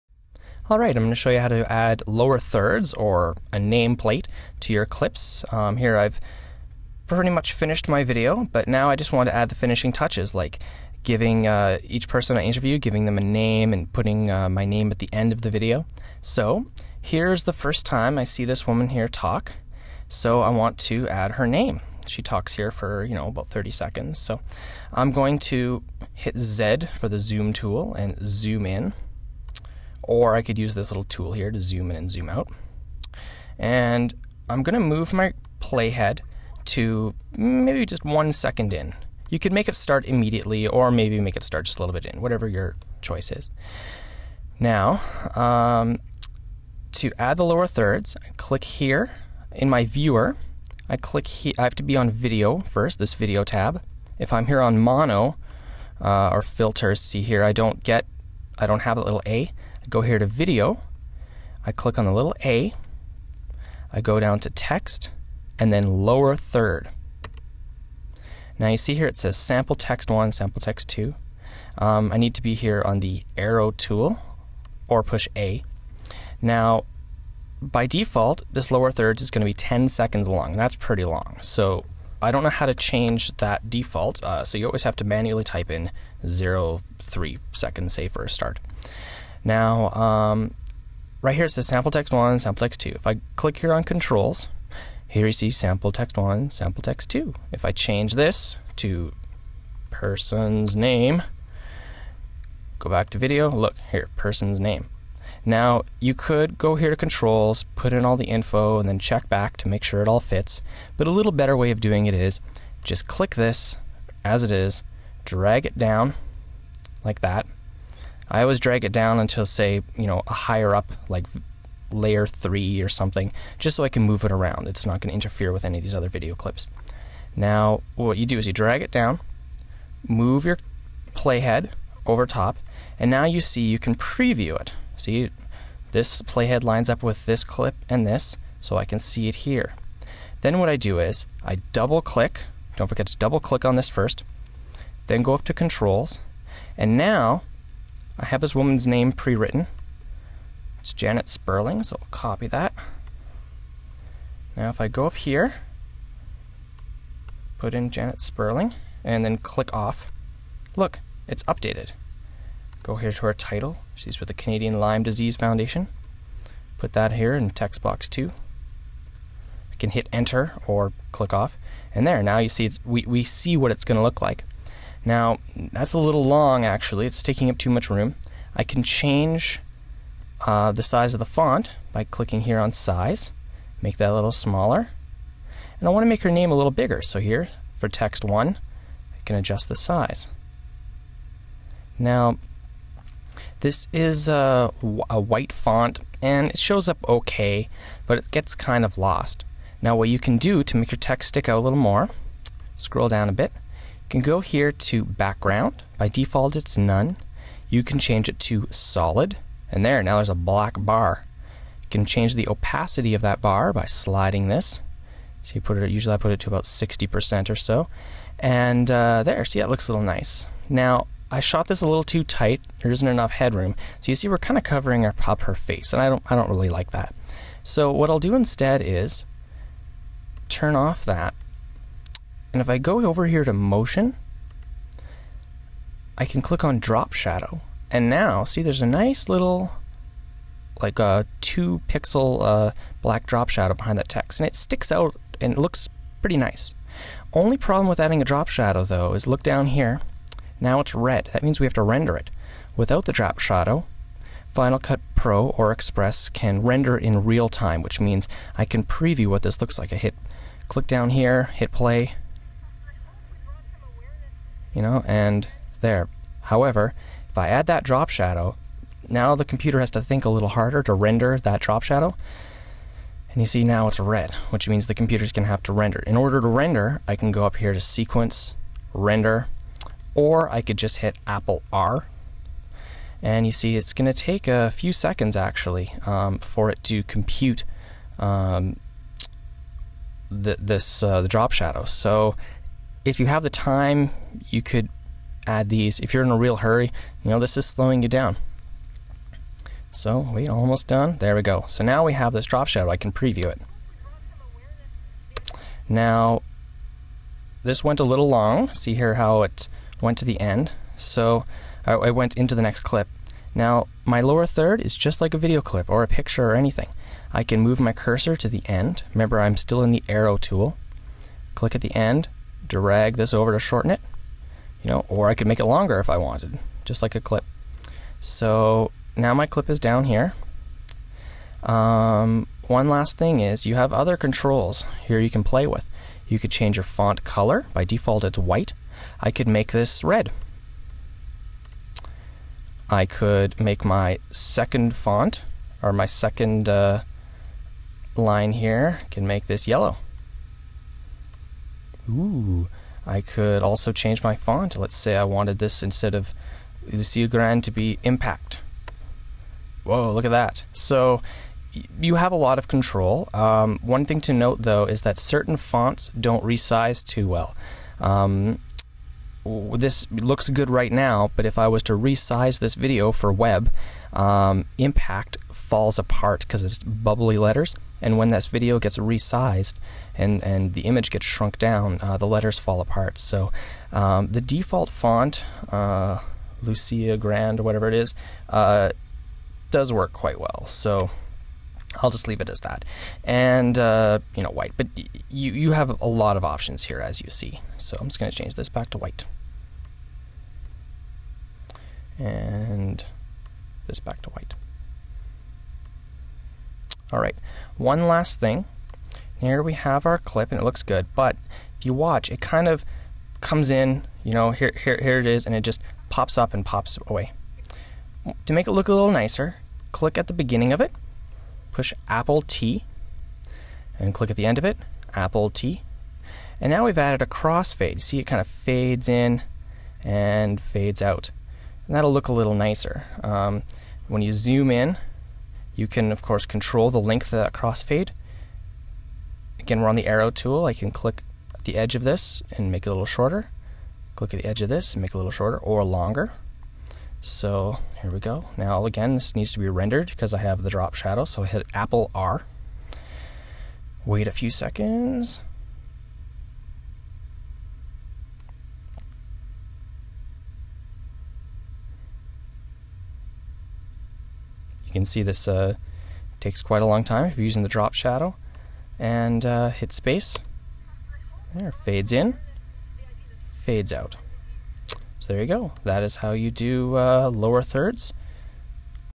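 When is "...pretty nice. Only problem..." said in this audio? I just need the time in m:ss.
4:06.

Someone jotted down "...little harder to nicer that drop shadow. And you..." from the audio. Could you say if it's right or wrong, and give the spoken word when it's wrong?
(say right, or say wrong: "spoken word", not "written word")
wrong: "render", not "nicer".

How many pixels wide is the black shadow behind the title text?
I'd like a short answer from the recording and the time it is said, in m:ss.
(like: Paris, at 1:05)
2, at 4:01.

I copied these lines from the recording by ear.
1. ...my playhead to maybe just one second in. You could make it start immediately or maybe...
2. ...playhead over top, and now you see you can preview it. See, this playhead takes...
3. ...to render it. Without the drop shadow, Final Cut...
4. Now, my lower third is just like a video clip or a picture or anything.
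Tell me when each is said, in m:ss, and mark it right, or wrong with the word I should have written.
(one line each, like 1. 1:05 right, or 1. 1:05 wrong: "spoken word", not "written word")
1. 0:35 right
2. 2:11 wrong: "lines", not "takes"
3. 4:11 right
4. 5:13 right.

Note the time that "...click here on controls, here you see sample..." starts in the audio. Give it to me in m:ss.
1:33.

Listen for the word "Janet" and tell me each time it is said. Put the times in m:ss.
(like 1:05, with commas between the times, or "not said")
2:30, 2:37.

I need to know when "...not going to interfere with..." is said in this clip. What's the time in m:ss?
2:04.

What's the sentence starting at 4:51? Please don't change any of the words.
So if you have the time, you could add these.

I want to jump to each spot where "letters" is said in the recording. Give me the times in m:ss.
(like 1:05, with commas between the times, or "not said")
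6:17, 6:22.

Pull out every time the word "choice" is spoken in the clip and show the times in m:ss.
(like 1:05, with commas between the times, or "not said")
0:43.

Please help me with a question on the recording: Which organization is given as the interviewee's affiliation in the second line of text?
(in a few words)
Canadian Lyme Disease Foundation.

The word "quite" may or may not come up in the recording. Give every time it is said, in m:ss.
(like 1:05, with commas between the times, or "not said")
6:30, 7:46.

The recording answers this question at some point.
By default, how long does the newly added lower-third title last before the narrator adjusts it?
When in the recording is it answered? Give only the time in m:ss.
1:19.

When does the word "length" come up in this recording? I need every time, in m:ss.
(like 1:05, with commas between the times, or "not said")
7:16.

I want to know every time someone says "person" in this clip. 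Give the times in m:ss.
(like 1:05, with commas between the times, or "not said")
0:12, 1:39, 1:44.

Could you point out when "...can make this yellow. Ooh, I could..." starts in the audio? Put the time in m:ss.
5:49.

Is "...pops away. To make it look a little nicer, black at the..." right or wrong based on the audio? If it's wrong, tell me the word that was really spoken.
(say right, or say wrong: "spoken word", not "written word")
wrong: "click", not "black".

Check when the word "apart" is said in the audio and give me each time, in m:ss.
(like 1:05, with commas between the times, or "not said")
6:15, 6:22.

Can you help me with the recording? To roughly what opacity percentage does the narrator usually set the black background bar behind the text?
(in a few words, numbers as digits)
60%.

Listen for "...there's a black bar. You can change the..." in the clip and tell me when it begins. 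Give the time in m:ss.
3:30.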